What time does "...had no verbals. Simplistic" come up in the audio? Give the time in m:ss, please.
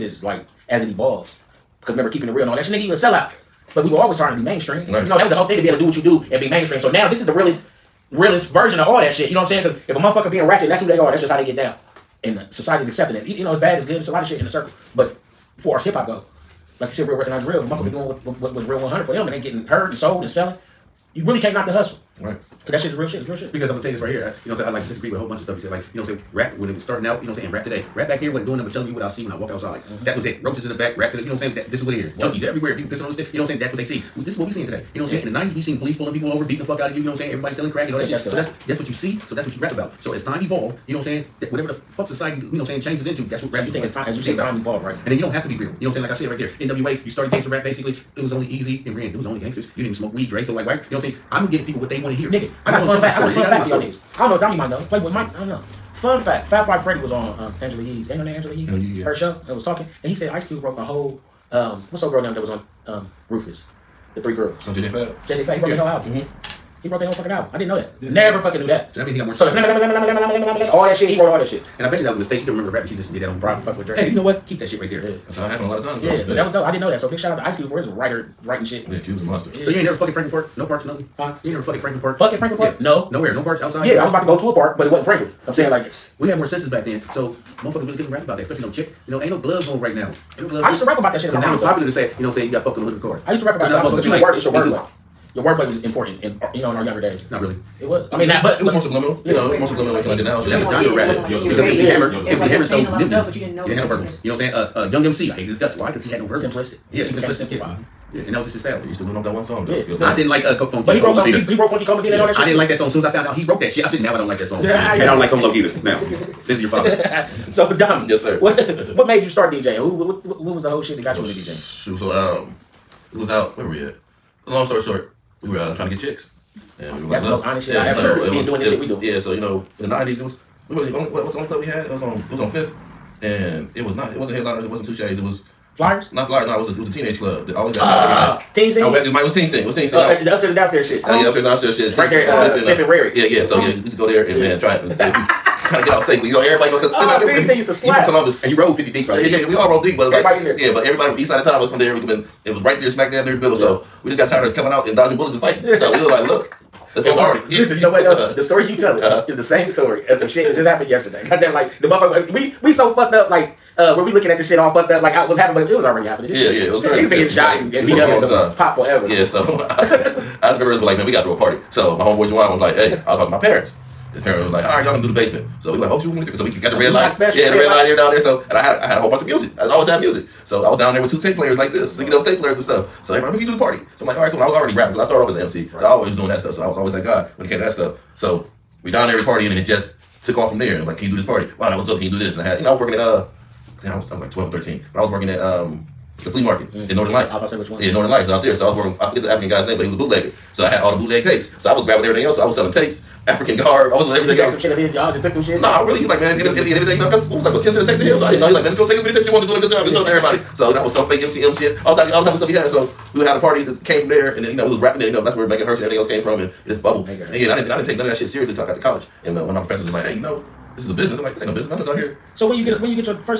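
1:46.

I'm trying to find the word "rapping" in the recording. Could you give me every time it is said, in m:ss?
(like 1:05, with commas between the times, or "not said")
3:04, 3:34.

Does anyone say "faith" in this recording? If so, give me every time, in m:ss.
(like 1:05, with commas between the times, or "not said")
not said.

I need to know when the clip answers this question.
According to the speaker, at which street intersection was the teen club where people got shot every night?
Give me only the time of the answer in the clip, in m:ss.
2:22.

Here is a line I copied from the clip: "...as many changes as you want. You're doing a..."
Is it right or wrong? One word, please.
wrong.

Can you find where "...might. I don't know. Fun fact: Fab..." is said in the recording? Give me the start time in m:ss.
0:55.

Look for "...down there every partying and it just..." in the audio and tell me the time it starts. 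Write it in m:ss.
3:08.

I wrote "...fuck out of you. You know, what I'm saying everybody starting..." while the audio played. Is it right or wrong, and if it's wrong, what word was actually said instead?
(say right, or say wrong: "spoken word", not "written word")
wrong: "selling", not "starting".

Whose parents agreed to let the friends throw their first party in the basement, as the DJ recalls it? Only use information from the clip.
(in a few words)
Juwan.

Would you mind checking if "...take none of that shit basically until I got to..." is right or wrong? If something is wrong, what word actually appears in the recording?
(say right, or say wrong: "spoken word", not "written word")
wrong: "seriously", not "basically".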